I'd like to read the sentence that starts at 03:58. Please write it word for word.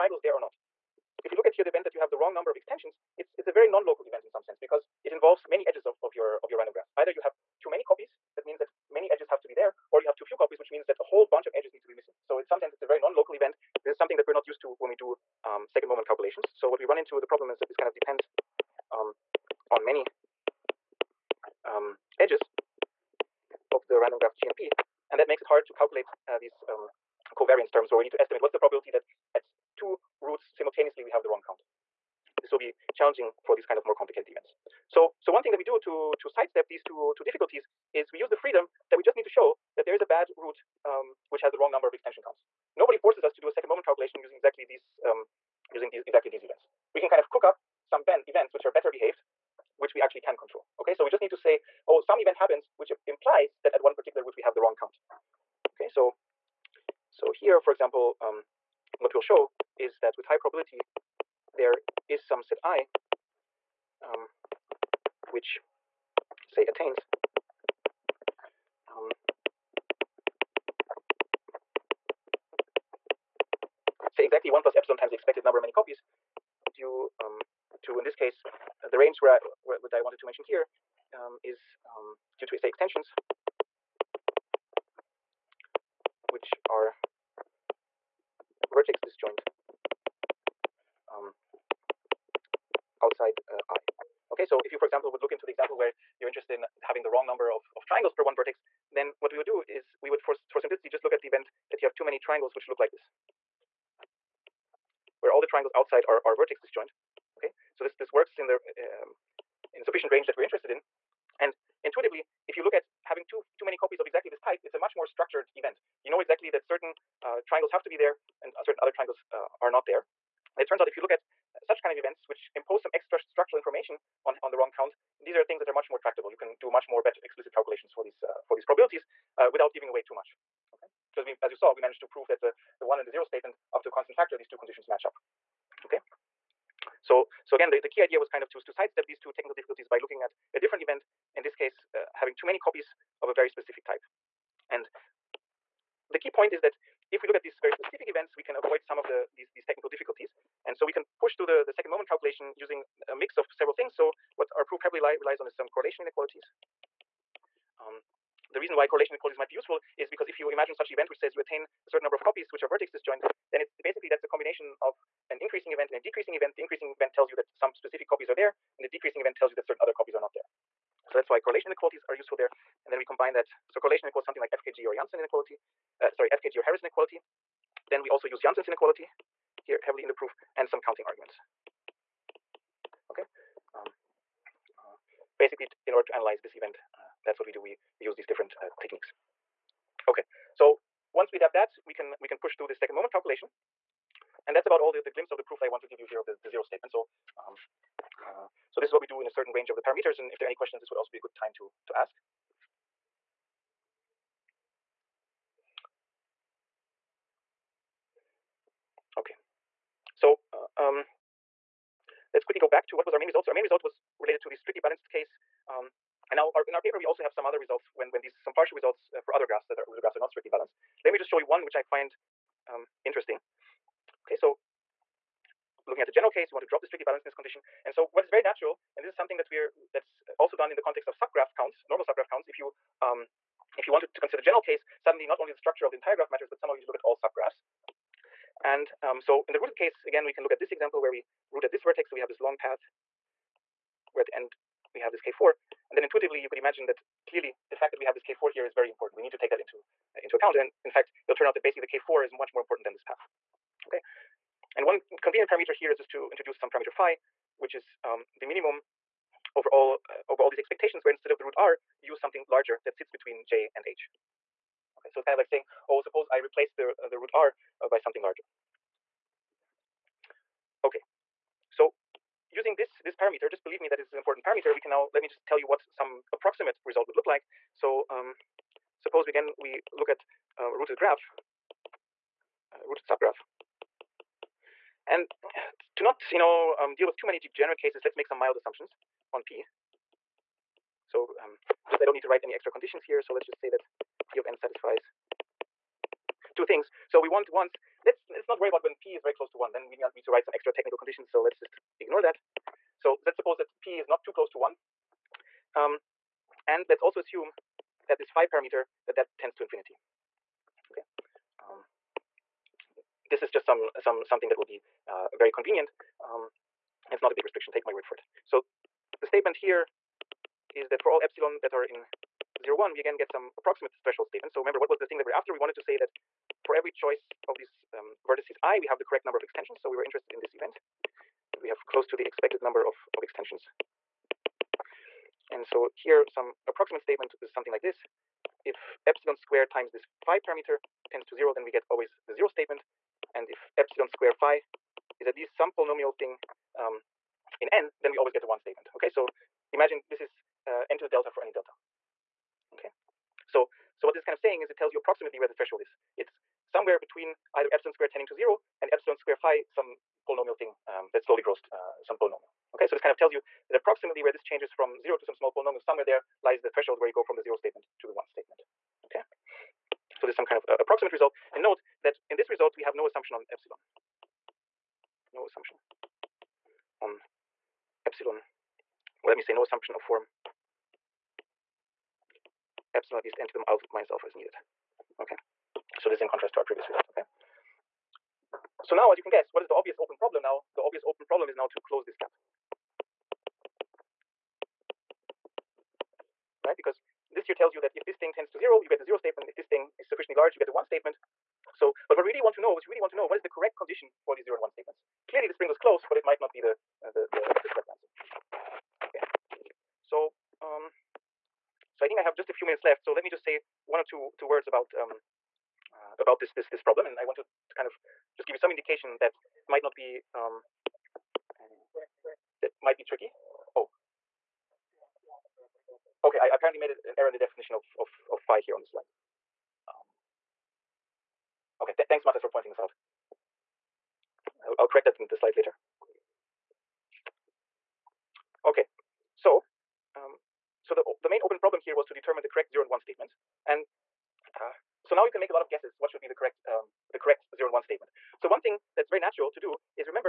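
And um, so in the rooted case, again, we can look at this example where we root at this vertex.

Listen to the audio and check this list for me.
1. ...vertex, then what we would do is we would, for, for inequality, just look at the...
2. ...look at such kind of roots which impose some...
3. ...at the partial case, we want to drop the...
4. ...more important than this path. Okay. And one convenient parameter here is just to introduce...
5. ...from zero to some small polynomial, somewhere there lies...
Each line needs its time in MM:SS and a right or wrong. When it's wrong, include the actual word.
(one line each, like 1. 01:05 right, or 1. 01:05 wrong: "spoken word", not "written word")
1. 01:38 wrong: "simplicity", not "inequality"
2. 02:01 wrong: "events", not "roots"
3. 03:45 wrong: "general", not "partial"
4. 04:12 right
5. 06:04 right.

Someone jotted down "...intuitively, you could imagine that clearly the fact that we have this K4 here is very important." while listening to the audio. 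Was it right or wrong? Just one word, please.
right.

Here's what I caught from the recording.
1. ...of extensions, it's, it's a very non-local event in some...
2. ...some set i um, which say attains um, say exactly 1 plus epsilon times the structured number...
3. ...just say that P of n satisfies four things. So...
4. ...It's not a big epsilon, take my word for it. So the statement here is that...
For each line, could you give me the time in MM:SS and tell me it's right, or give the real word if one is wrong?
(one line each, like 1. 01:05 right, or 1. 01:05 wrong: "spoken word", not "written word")
1. 00:02 right
2. 01:02 wrong: "expected", not "structured"
3. 04:53 wrong: "two", not "four"
4. 05:17 wrong: "restriction", not "epsilon".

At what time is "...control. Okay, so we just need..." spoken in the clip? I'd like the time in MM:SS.
00:50.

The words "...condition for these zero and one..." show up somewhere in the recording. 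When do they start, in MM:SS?
06:43.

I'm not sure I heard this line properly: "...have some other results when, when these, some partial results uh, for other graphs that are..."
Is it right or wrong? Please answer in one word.
right.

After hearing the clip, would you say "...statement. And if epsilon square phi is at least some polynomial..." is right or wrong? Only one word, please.
right.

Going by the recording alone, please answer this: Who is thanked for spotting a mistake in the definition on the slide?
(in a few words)
Matas.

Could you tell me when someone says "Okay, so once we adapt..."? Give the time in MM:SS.
03:10.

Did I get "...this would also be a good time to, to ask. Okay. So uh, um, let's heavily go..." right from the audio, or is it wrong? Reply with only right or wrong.
wrong.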